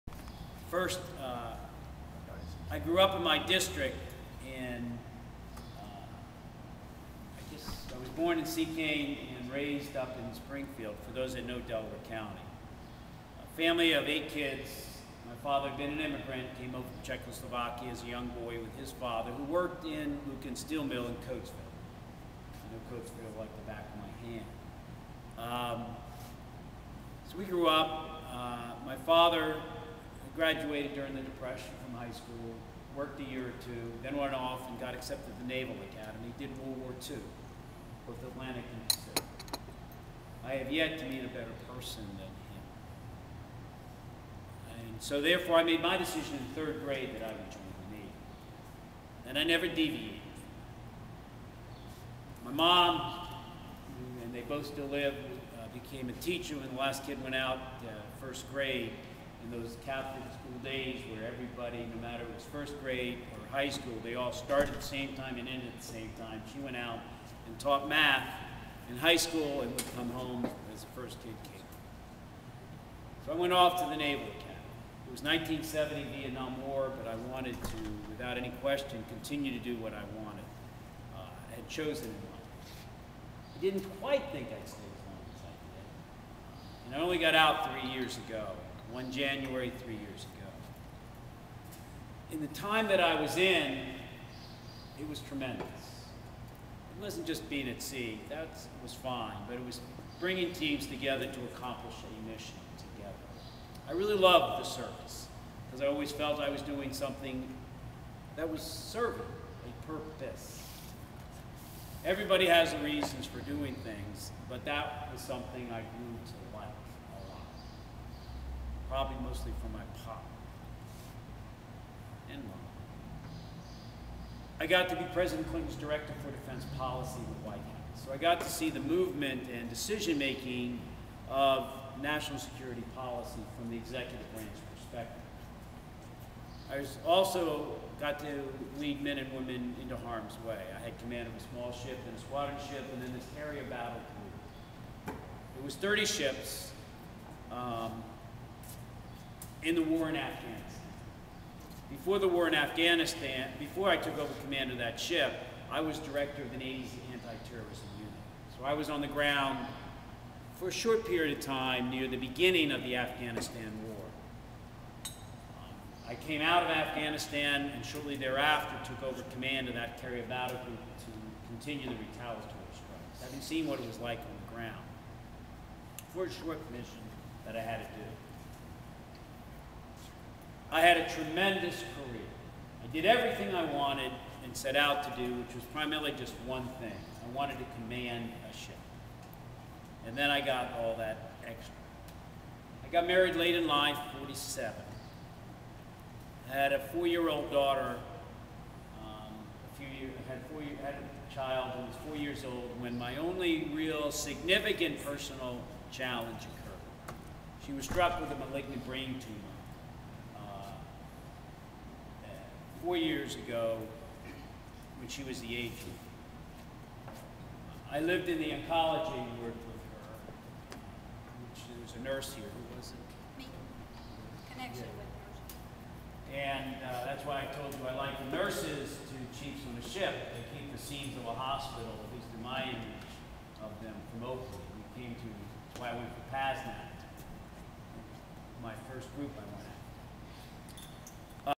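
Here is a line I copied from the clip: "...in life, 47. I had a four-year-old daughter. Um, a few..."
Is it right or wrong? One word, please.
right.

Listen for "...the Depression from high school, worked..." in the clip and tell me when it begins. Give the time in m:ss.
0:31.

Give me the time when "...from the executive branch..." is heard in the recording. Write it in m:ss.
2:13.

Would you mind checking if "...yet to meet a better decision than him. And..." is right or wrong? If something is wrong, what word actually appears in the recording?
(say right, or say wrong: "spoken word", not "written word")
wrong: "person", not "decision".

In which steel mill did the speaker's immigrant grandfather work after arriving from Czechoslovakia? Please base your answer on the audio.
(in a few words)
Lukens Steel Mill.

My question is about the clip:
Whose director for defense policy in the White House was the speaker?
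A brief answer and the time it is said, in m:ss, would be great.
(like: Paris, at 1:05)
President Clinton, at 2:05.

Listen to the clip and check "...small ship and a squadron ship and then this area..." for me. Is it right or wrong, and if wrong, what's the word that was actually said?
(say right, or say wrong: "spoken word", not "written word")
right.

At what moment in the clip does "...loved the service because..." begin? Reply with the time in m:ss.
1:44.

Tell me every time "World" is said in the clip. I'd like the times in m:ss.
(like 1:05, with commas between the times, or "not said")
0:36.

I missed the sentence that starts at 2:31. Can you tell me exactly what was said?
Before the war in Afghanistan, before I took over command of that ship, I was director of the Navy's anti-terrorism unit.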